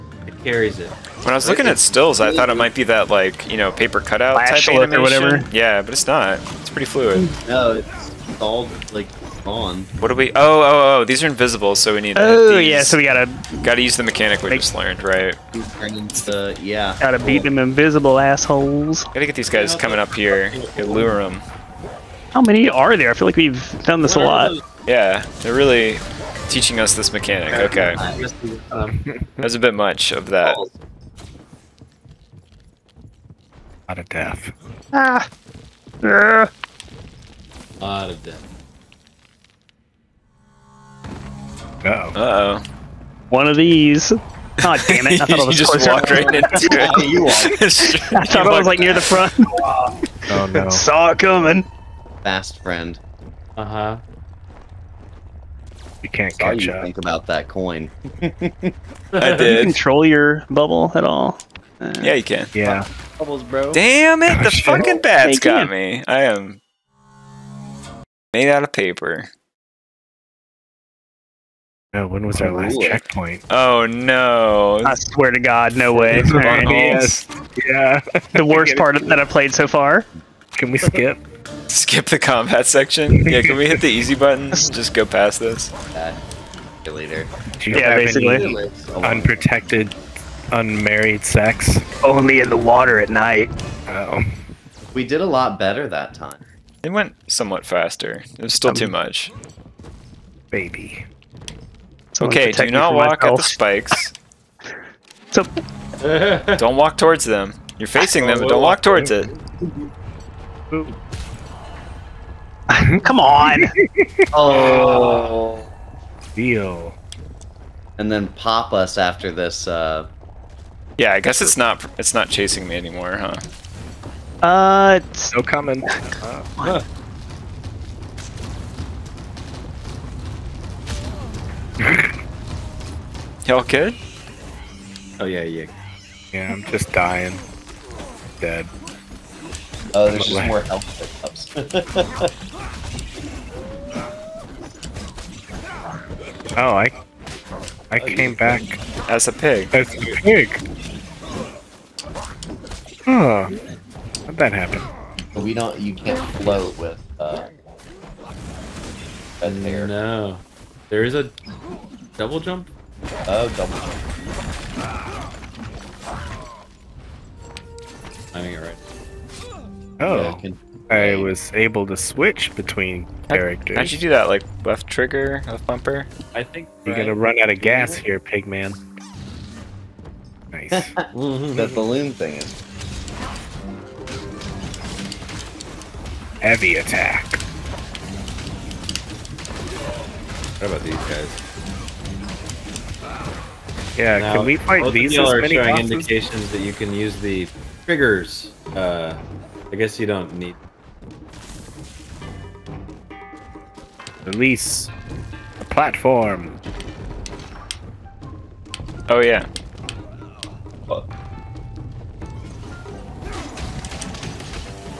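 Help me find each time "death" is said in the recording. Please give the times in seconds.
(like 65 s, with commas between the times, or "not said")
34 s, 38 s.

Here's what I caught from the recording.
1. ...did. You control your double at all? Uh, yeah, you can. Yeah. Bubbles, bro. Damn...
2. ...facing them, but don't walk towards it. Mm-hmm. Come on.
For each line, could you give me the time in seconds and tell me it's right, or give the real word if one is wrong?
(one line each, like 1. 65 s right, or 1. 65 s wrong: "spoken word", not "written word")
1. 59 s wrong: "bubble", not "double"
2. 107 s right.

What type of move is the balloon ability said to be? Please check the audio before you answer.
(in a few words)
heavy attack.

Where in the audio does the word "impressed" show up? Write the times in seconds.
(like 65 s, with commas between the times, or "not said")
not said.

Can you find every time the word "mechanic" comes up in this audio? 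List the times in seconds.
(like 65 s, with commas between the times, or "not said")
14 s, 27 s.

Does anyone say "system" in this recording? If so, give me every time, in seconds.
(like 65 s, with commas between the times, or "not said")
not said.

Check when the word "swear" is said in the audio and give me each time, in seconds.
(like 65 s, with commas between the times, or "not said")
74 s.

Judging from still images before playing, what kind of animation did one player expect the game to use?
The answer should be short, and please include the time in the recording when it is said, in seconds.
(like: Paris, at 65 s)
paper cutout, at 3 s.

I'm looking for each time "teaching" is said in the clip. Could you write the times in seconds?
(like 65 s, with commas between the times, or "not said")
26 s.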